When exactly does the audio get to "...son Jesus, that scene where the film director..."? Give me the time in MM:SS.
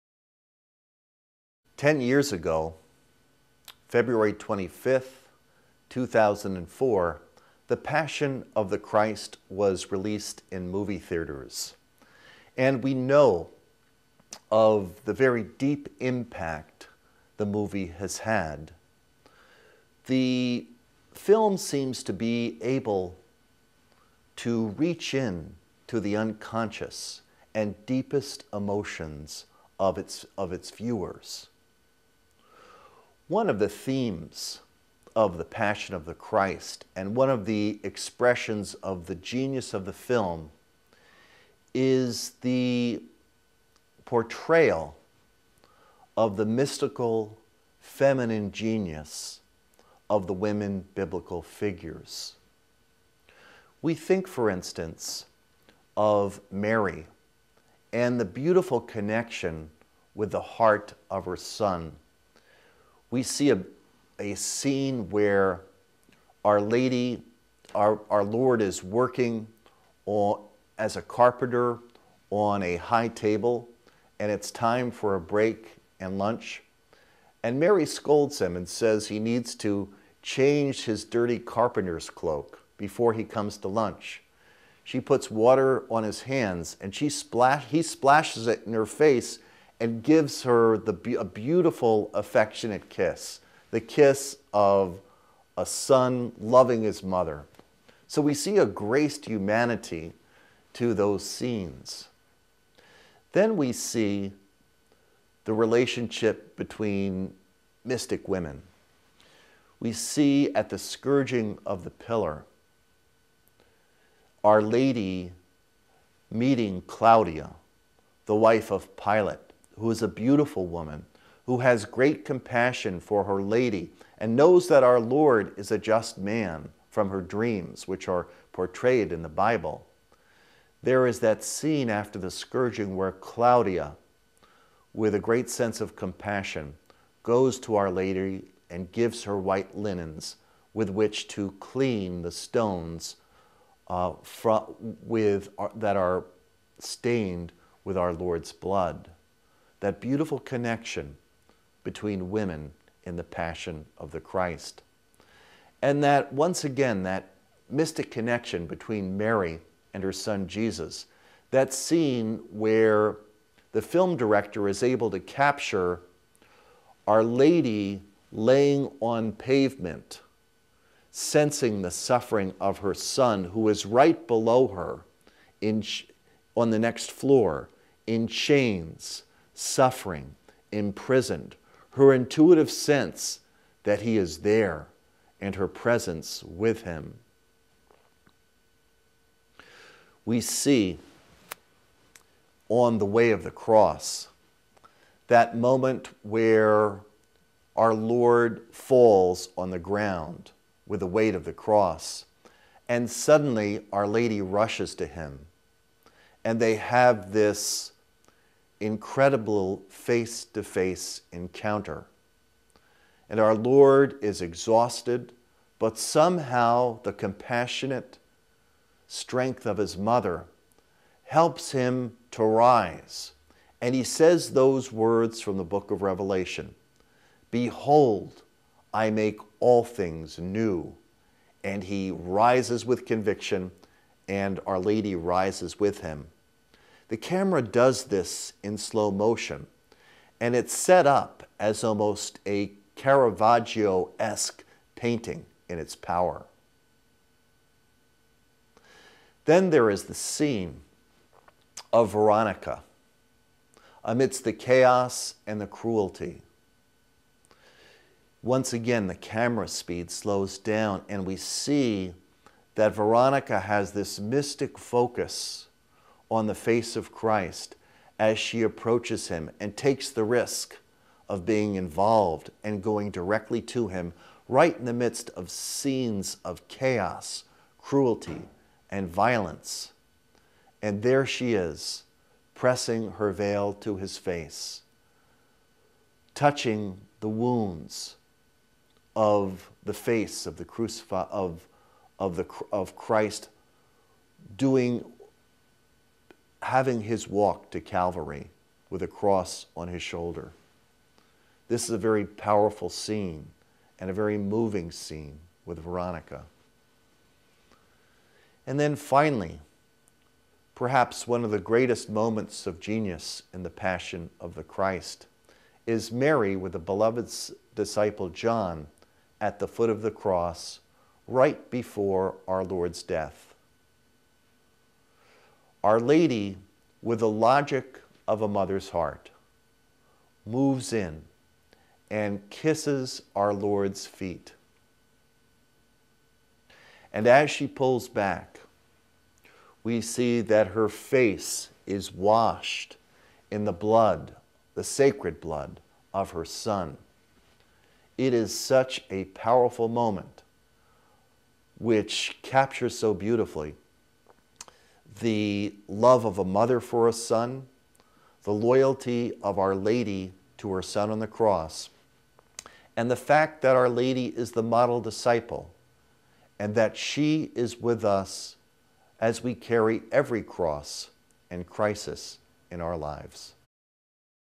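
02:40.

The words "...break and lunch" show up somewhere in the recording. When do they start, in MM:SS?
01:15.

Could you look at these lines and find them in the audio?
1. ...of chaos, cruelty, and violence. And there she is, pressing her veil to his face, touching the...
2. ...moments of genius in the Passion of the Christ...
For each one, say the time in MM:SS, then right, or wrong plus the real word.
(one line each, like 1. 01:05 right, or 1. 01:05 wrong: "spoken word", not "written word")
1. 04:36 right
2. 05:12 right.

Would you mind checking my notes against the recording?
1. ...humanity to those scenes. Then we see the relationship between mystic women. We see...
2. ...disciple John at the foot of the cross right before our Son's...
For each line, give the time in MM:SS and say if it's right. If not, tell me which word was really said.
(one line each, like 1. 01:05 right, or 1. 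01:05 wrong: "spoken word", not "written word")
1. 01:39 right
2. 05:17 wrong: "Lord", not "Son".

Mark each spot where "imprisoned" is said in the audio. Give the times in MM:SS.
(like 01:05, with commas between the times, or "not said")
03:00.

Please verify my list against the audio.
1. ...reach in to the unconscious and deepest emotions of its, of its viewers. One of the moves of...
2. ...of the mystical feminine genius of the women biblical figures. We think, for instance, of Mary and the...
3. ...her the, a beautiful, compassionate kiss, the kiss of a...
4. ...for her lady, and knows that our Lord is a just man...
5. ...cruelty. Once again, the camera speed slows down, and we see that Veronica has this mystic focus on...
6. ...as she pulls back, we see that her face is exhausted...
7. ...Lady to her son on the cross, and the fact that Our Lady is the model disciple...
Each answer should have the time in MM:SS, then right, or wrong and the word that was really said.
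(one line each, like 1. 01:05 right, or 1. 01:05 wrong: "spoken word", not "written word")
1. 00:24 wrong: "themes", not "moves"
2. 00:46 right
3. 01:30 wrong: "affectionate", not "compassionate"
4. 02:02 right
5. 04:15 right
6. 05:37 wrong: "washed", not "exhausted"
7. 05:59 right.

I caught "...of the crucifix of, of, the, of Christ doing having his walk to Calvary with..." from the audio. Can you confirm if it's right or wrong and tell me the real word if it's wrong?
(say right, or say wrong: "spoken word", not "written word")
right.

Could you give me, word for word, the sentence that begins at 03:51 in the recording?
And he rises with conviction, and Our Lady rises with him.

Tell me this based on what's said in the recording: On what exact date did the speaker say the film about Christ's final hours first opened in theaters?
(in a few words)
February 25th, 2004.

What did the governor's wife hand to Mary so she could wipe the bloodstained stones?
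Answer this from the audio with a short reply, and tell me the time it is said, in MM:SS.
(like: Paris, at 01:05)
white linens, at 02:19.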